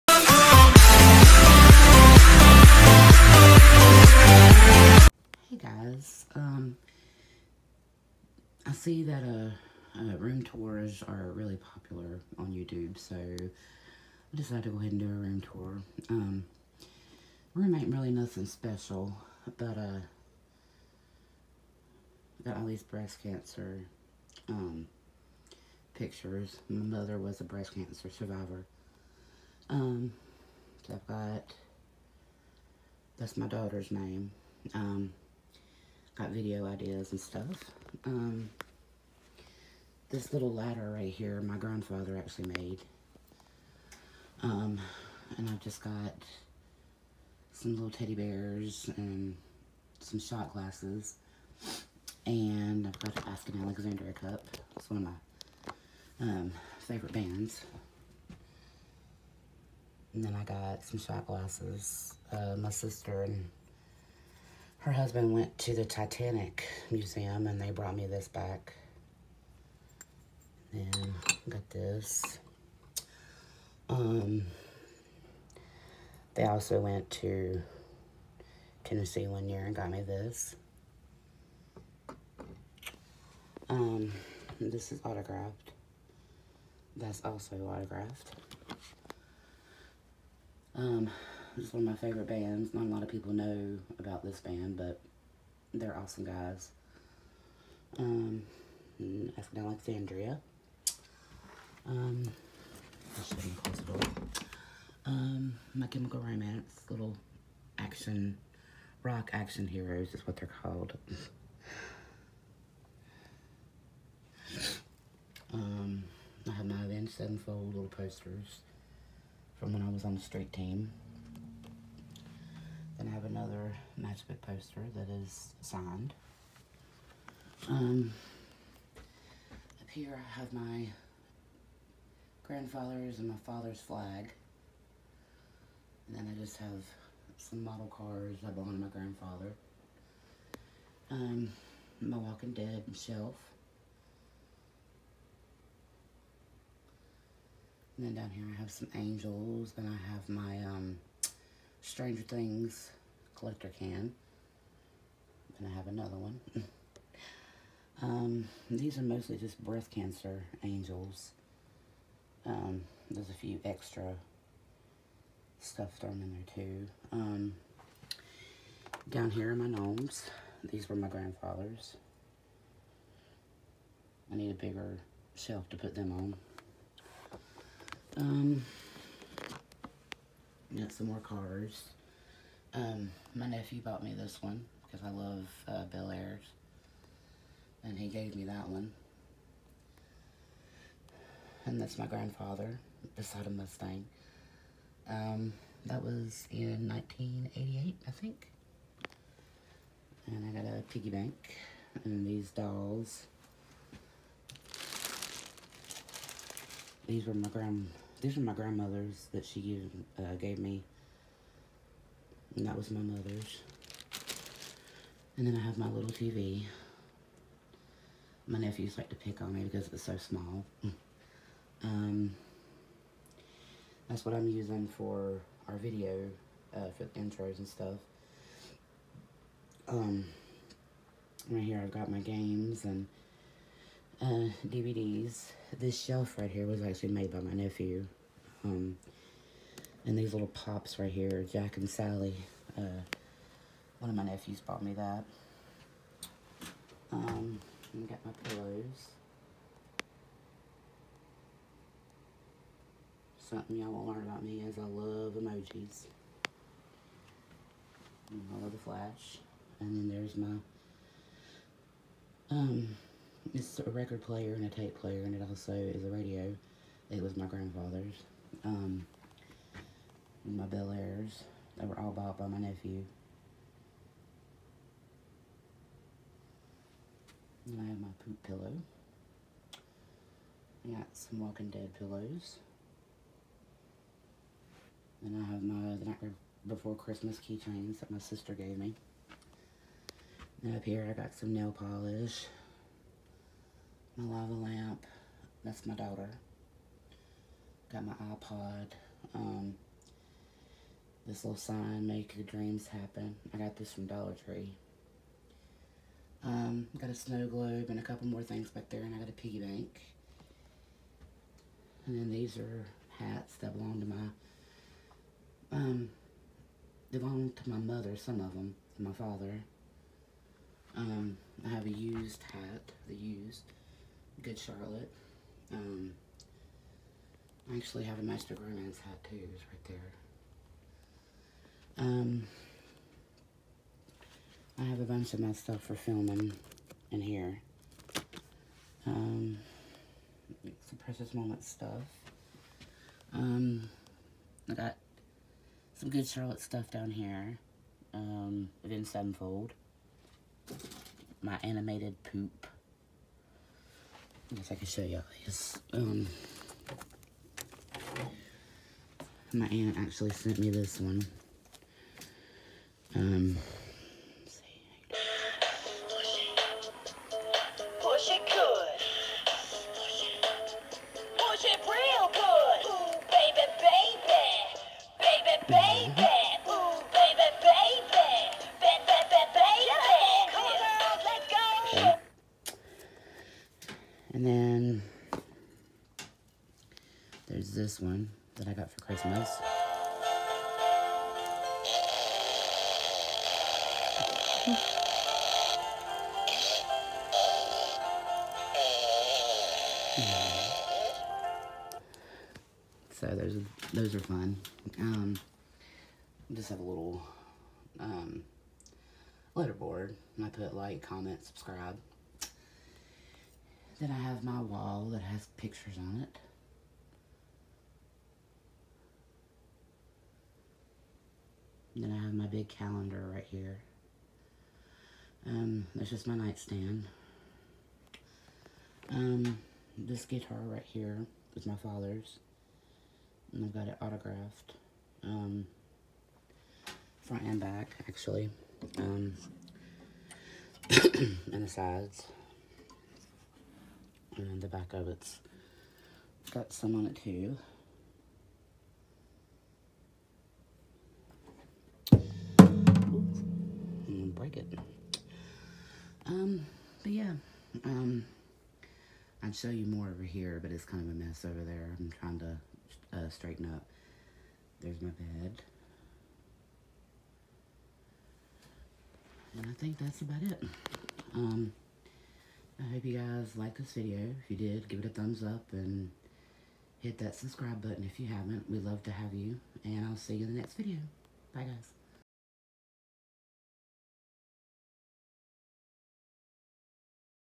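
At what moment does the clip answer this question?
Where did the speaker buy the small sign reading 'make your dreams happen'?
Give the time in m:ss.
5:04.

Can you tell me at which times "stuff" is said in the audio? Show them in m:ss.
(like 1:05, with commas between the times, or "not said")
0:37, 2:45, 3:47, 5:35, 5:41, 5:46.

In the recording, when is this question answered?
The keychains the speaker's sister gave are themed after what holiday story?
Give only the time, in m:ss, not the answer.
4:45.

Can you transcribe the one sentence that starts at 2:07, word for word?
Um, up here I have my grandfather's and my father's flag.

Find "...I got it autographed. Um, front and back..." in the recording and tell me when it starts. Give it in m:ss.
7:13.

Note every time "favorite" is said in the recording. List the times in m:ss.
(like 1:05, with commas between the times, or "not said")
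0:56, 1:32.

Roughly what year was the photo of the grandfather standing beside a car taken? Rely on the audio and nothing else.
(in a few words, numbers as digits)
1988.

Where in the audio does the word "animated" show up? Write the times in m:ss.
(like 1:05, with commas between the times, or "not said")
5:51.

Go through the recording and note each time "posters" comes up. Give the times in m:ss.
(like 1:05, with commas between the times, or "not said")
1:57, 2:04.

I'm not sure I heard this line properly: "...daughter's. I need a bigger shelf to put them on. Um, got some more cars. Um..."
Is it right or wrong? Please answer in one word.
wrong.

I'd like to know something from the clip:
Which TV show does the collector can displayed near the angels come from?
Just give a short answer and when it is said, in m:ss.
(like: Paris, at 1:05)
Stranger Things, at 2:31.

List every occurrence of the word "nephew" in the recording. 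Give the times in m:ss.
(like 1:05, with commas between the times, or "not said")
3:03, 3:38, 3:57, 4:04, 4:32.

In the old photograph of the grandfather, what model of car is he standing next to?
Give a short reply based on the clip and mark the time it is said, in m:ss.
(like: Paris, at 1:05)
Mustang, at 3:13.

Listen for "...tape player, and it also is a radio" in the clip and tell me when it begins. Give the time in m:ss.
4:24.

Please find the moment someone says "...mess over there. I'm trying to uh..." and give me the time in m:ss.
7:41.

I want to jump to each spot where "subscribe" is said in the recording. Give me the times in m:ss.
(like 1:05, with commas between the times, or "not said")
6:51, 7:57.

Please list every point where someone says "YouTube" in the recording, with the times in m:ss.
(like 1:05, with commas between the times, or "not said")
0:12.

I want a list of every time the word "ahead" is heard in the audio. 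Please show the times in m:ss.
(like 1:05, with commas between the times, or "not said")
0:14.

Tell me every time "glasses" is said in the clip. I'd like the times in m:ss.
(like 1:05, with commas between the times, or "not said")
0:50, 1:01.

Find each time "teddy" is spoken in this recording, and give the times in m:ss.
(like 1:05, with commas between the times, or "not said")
0:47.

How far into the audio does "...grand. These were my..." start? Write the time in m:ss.
3:27.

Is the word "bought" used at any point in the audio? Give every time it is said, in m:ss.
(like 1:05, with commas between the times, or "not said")
3:03, 4:04, 4:32.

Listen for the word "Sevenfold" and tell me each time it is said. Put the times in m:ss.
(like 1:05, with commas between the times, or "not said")
1:57, 5:49.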